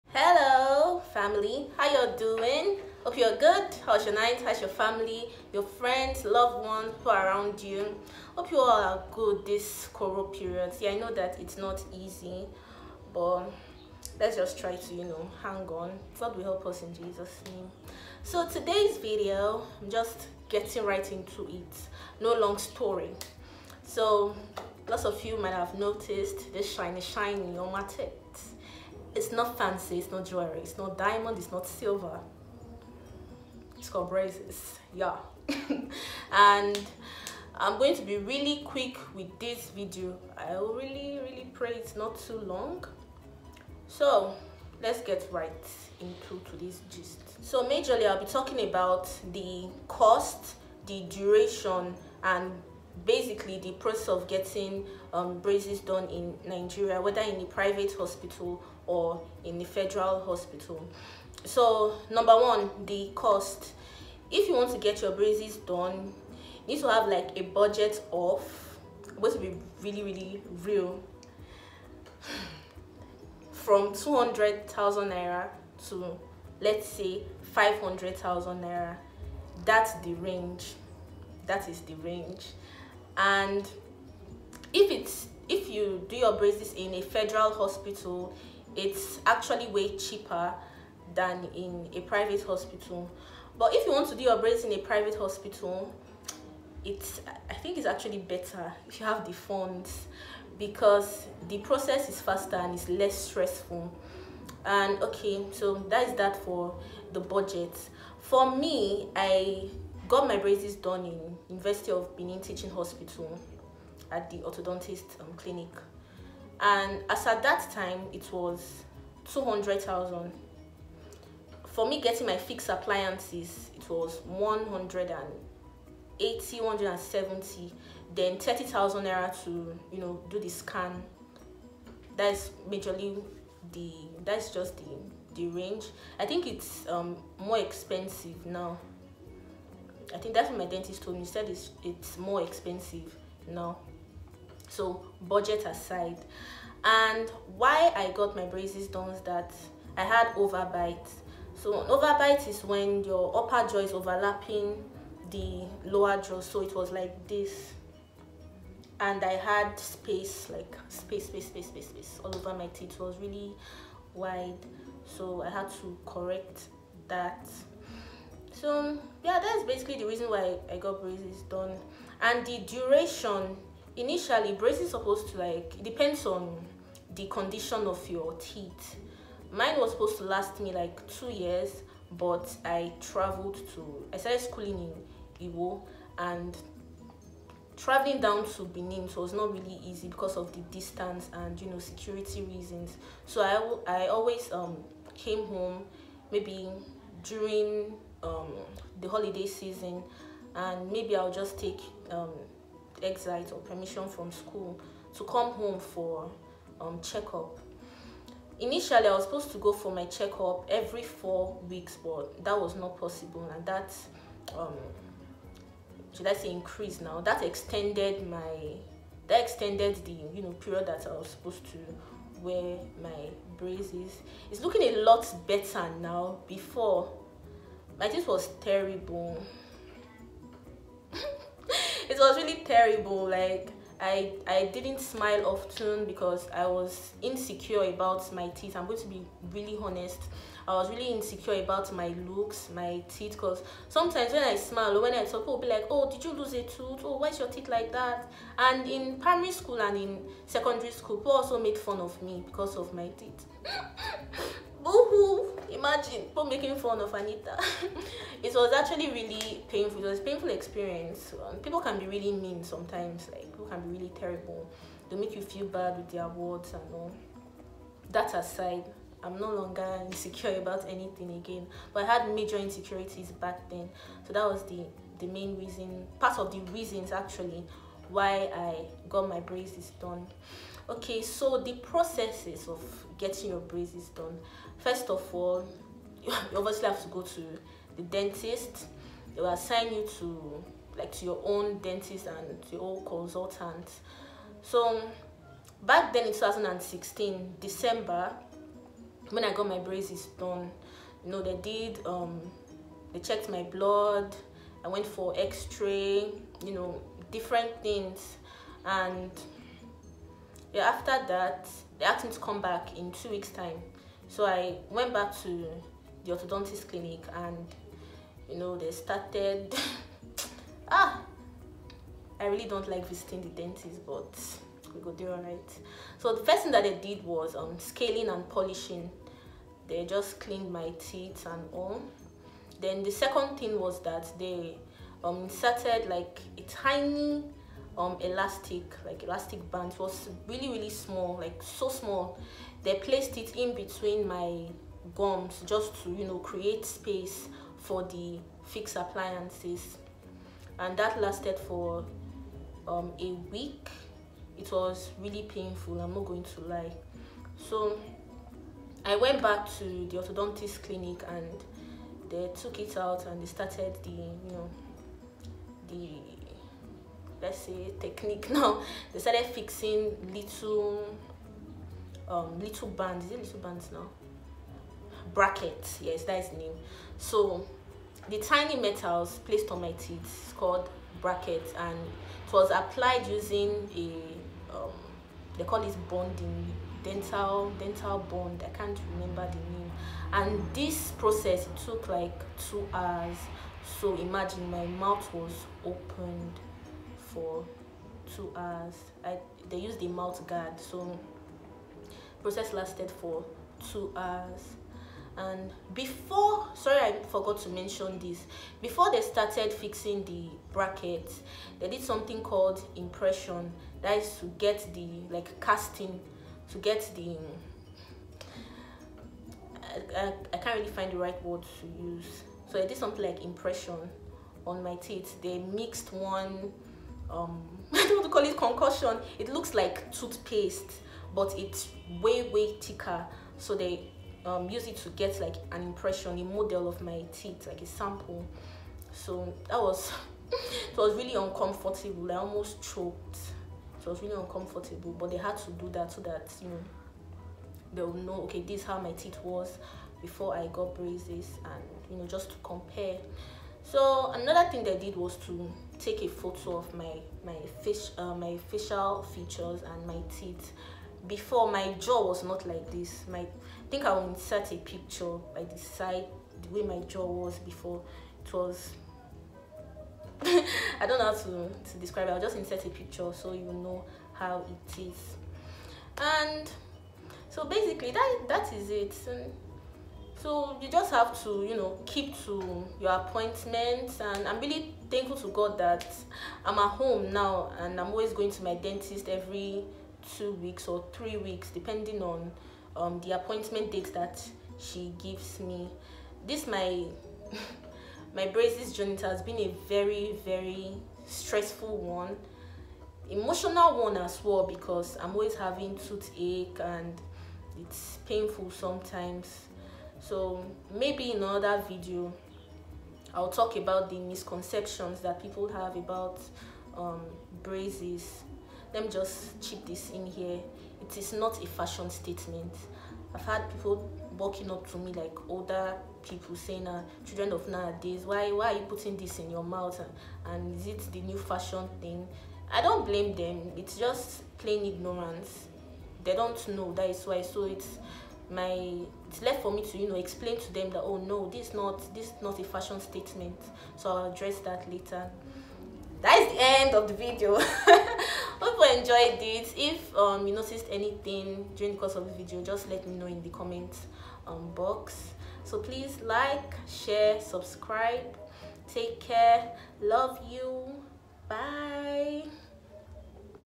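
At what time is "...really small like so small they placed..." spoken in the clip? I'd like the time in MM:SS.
05:40.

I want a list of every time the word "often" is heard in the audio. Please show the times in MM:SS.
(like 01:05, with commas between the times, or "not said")
03:55.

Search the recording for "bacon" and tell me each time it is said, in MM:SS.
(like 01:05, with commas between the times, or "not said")
not said.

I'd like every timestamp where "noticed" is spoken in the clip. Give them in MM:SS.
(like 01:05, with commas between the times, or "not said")
00:25, 09:10.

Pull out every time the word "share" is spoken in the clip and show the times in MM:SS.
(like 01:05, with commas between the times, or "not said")
09:16.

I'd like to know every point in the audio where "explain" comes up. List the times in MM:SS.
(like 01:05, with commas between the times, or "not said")
09:00.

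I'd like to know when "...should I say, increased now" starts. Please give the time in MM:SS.
03:36.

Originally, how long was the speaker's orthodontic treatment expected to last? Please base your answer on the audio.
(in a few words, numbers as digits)
2 years.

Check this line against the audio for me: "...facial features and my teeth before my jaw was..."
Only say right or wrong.
right.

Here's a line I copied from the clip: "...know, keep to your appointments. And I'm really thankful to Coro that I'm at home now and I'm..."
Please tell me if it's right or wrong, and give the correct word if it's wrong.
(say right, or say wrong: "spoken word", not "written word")
wrong: "God", not "Coro".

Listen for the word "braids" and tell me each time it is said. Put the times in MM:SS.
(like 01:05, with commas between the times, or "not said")
01:34.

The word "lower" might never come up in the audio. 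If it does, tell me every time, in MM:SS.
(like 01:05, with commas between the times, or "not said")
02:35.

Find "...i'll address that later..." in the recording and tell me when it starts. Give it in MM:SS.
09:04.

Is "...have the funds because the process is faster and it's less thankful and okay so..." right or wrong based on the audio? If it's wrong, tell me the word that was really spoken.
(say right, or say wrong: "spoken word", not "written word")
wrong: "stressful", not "thankful".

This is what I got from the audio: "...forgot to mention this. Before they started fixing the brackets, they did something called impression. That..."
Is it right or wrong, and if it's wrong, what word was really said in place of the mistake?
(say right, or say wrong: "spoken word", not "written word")
right.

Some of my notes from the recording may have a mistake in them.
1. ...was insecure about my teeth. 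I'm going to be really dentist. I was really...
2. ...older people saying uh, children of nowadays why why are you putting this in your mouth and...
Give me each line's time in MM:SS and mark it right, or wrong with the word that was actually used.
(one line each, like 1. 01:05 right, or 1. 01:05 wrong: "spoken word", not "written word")
1. 03:56 wrong: "honest", not "dentist"
2. 08:45 right.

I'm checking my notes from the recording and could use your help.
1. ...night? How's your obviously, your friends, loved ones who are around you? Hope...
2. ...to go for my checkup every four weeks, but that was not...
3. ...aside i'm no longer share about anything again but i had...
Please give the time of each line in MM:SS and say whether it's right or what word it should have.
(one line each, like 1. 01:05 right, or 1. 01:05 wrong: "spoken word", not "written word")
1. 00:04 wrong: "family", not "obviously"
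2. 03:29 right
3. 04:28 wrong: "insecure", not "share".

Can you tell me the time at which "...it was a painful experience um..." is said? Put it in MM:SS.
04:20.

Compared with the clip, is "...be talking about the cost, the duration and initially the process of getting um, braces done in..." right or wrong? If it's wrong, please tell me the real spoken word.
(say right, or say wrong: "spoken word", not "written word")
wrong: "basically", not "initially".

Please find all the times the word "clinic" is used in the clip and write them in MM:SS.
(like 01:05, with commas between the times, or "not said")
01:55, 05:16, 06:00.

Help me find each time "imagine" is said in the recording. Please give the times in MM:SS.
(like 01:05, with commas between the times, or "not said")
04:15, 06:34.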